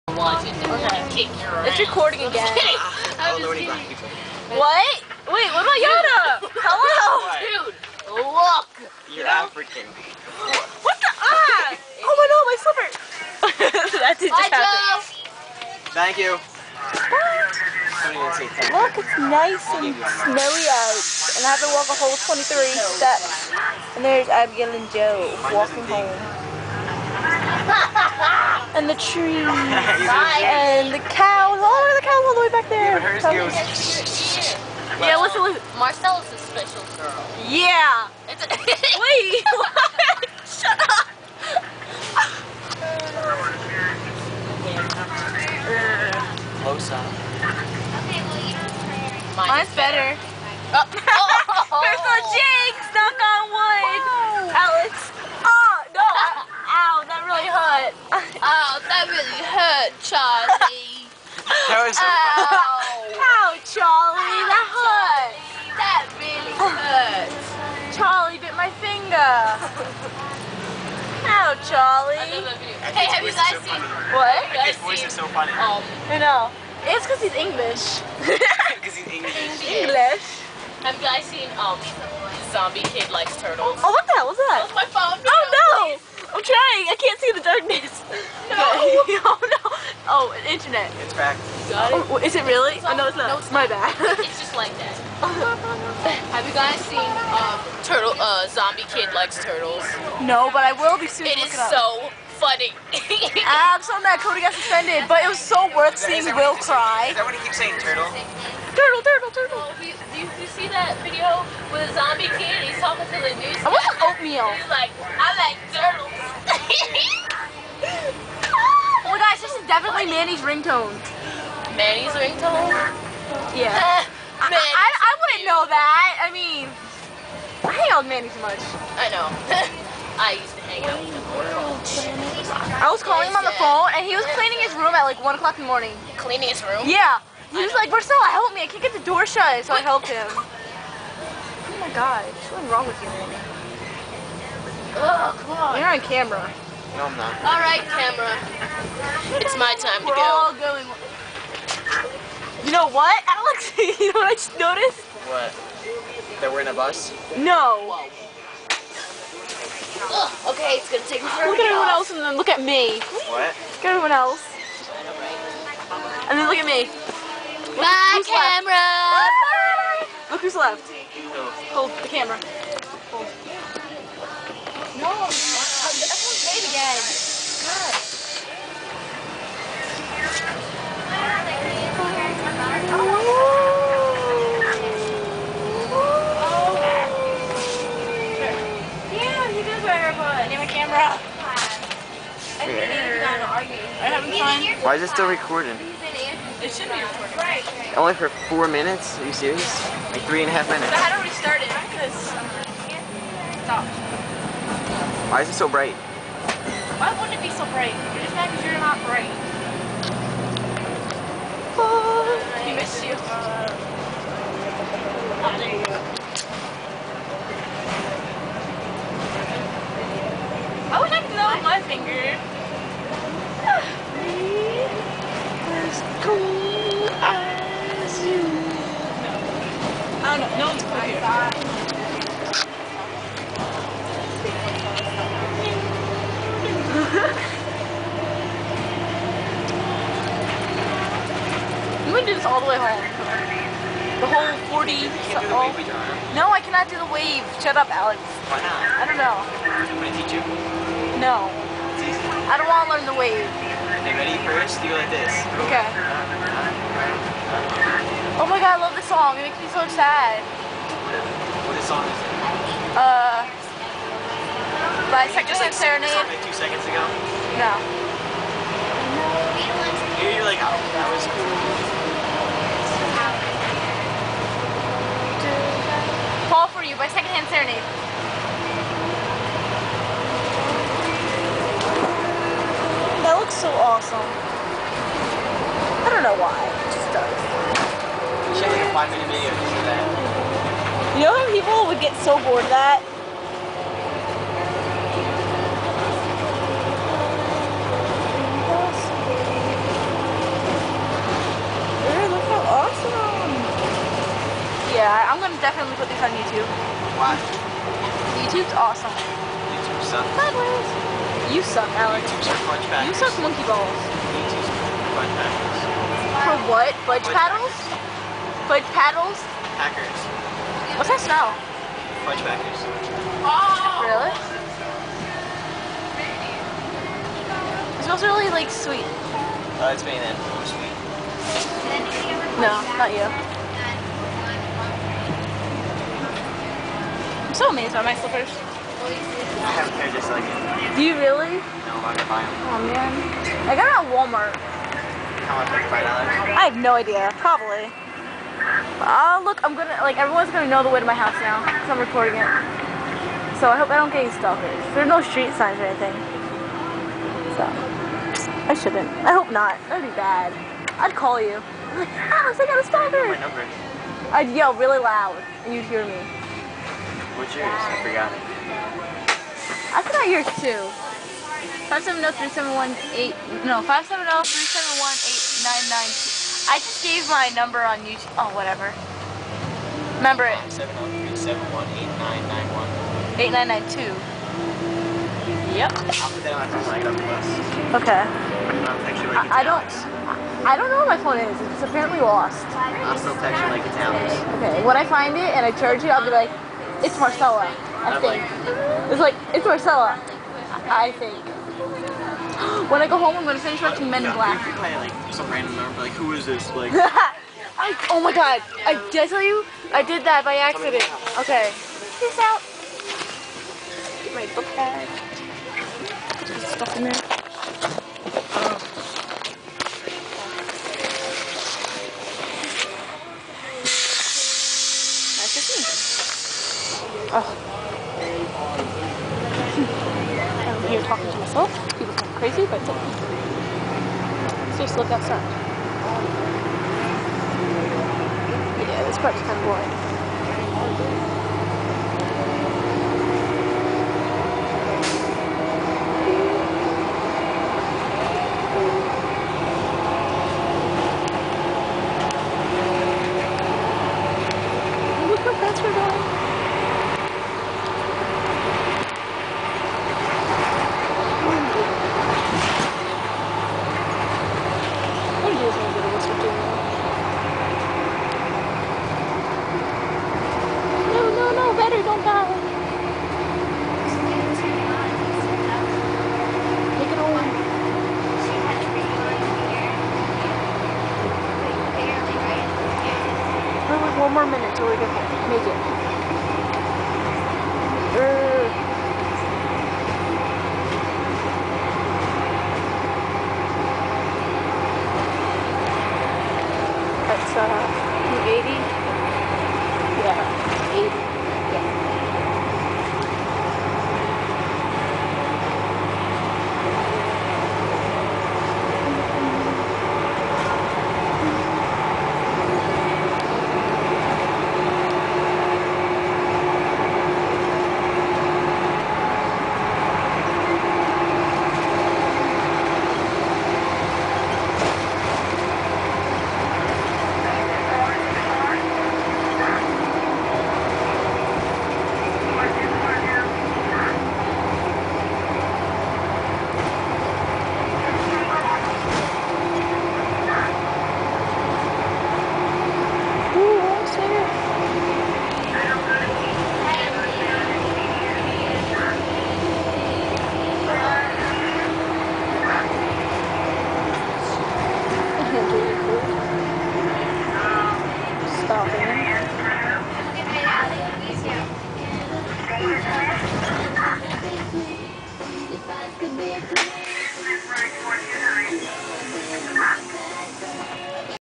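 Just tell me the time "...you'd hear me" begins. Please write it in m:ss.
6:05.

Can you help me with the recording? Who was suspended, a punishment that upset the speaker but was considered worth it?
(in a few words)
Cody.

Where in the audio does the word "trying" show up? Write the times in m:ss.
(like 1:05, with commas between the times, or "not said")
1:26.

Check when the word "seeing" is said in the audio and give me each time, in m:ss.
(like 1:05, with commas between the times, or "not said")
1:45.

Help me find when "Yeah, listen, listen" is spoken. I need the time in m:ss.
0:35.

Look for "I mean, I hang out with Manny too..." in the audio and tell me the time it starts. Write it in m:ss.
2:06.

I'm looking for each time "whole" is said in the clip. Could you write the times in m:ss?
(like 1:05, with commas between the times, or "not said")
0:22, 4:04.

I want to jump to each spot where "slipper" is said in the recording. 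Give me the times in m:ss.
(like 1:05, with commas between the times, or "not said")
0:12, 5:38.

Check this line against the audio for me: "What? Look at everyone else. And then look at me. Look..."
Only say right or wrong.
right.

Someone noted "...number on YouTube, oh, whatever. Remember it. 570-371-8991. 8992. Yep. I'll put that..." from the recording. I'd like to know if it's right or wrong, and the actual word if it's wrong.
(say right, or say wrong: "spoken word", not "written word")
right.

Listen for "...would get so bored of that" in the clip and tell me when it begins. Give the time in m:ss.
4:51.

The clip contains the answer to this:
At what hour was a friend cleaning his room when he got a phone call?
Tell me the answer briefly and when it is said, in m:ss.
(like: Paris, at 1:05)
1 o'clock, at 2:15.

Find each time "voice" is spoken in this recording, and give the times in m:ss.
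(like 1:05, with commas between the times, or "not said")
1:14.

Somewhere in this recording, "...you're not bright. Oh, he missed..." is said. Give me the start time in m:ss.
3:28.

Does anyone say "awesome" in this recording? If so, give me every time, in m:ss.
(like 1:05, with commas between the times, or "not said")
4:43, 5:08.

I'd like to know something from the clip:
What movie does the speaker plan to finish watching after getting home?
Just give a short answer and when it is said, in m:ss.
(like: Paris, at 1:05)
Men in Black, at 6:44.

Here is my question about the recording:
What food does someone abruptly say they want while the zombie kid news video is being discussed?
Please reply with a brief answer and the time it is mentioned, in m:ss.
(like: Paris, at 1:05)
Oatmeal, at 1:53.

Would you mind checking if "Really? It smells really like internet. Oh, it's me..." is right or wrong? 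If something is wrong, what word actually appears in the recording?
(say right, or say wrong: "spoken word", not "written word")
wrong: "sweet", not "internet".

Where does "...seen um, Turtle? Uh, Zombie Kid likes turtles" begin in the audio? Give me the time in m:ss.
1:36.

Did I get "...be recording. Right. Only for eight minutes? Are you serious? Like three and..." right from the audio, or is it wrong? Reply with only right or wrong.
wrong.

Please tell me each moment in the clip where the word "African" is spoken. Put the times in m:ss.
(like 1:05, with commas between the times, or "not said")
0:09.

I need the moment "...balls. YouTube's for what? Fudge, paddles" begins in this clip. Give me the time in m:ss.
5:13.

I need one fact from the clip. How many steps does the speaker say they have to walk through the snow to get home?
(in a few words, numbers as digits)
23.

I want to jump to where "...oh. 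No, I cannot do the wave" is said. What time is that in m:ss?
4:05.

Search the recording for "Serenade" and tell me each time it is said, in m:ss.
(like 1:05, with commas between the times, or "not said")
4:25, 4:37.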